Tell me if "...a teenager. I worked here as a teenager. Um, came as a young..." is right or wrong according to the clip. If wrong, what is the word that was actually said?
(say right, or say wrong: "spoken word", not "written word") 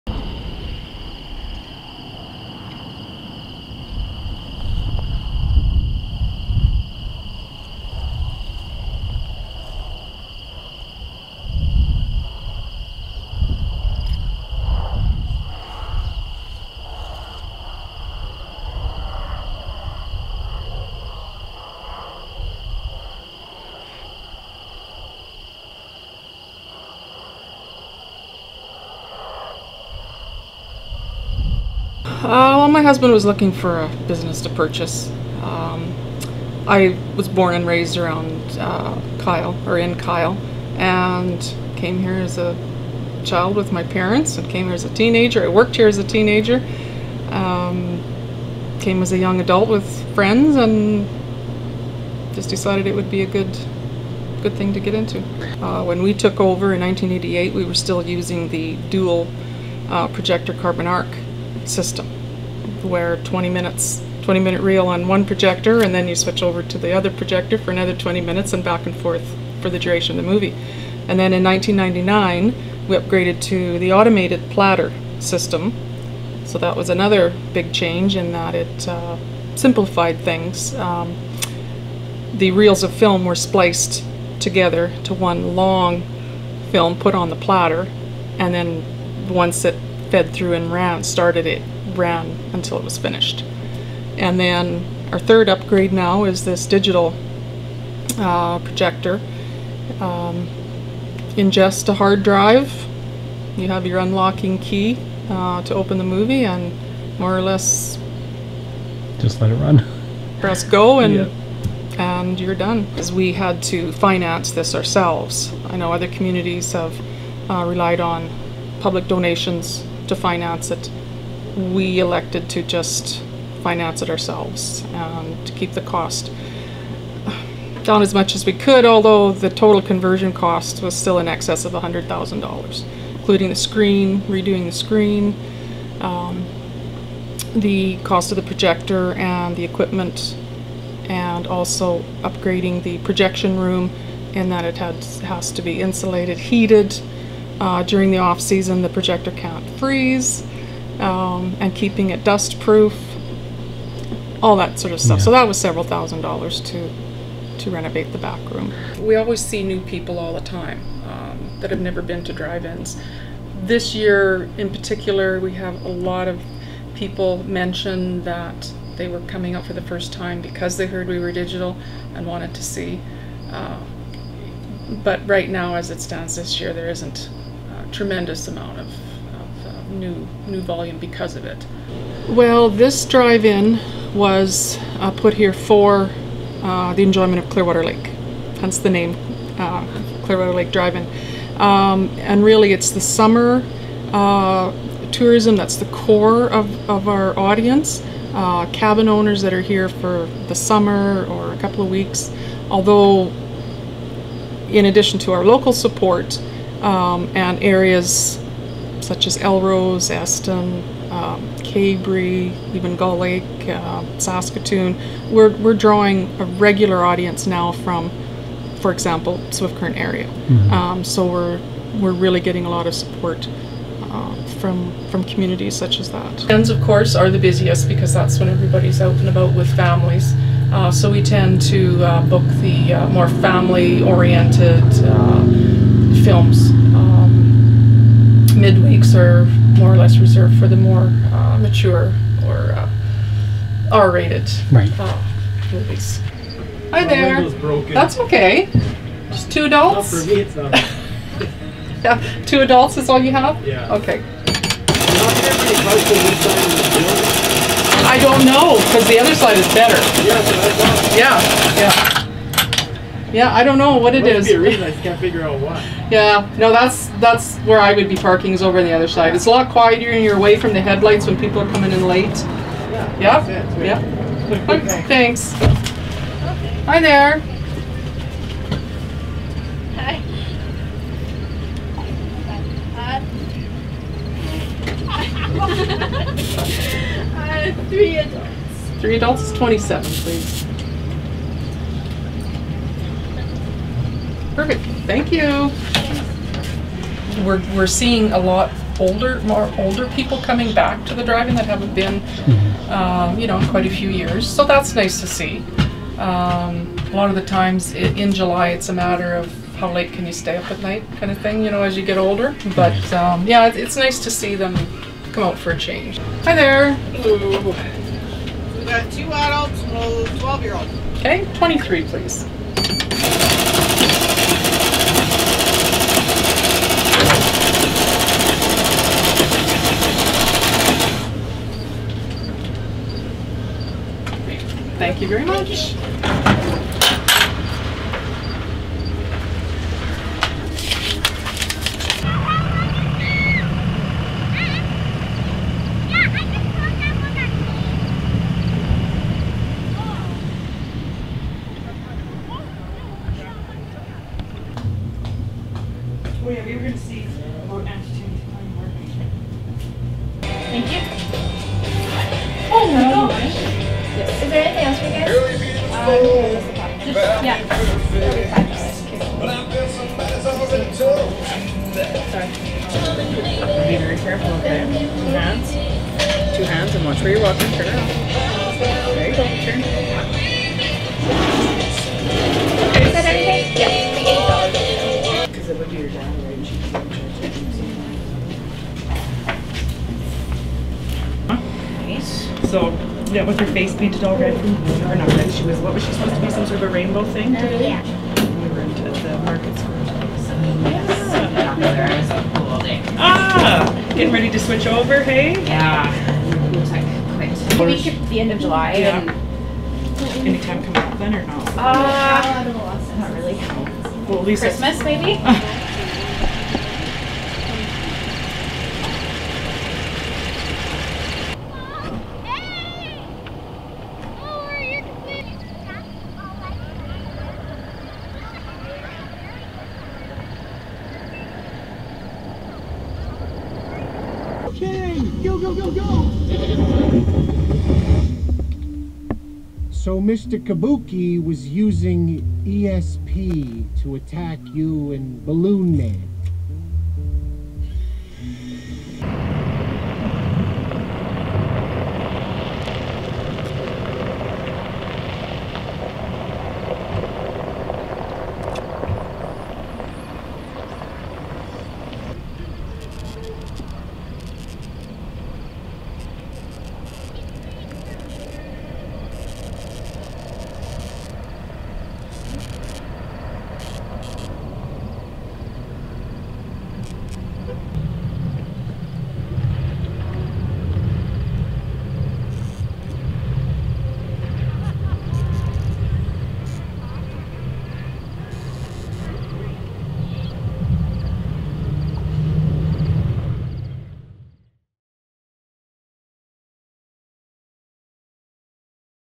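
right.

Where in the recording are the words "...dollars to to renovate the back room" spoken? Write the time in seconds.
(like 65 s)
156 s.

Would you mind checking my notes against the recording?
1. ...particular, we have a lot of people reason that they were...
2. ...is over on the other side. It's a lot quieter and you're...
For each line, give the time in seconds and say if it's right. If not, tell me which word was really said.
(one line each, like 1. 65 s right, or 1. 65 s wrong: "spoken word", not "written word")
1. 164 s wrong: "mention", not "reason"
2. 268 s right.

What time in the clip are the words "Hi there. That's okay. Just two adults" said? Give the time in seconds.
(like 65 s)
246 s.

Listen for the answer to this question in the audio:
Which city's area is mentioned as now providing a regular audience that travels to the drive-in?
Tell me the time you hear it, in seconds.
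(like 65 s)
219 s.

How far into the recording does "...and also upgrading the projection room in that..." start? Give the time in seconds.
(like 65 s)
141 s.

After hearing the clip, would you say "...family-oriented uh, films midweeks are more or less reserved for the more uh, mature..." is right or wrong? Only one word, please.
right.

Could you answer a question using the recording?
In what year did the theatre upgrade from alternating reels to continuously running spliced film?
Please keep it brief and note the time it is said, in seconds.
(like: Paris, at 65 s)
1999, at 71 s.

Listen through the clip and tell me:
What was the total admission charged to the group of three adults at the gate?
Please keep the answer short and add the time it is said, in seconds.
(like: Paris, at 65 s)
$27, at 289 s.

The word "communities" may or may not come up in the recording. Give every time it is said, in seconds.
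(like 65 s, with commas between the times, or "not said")
116 s, 225 s.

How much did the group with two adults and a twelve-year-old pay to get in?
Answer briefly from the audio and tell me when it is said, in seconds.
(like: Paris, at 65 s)
$23, at 321 s.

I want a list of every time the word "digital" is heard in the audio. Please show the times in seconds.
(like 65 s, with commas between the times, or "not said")
96 s, 171 s.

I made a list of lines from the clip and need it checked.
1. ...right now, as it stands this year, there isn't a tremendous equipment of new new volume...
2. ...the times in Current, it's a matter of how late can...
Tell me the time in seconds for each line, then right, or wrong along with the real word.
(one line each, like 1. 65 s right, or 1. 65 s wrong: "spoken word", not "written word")
1. 175 s wrong: "amount", not "equipment"
2. 307 s wrong: "July", not "Current".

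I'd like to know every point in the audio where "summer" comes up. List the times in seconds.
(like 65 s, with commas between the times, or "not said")
193 s, 200 s.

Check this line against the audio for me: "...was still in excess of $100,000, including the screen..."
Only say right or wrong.
right.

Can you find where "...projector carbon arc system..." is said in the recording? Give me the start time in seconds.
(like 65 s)
60 s.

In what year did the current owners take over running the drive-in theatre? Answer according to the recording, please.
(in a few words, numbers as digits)
1988.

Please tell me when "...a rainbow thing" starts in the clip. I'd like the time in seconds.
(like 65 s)
396 s.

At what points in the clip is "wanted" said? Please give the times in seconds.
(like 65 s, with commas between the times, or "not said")
172 s.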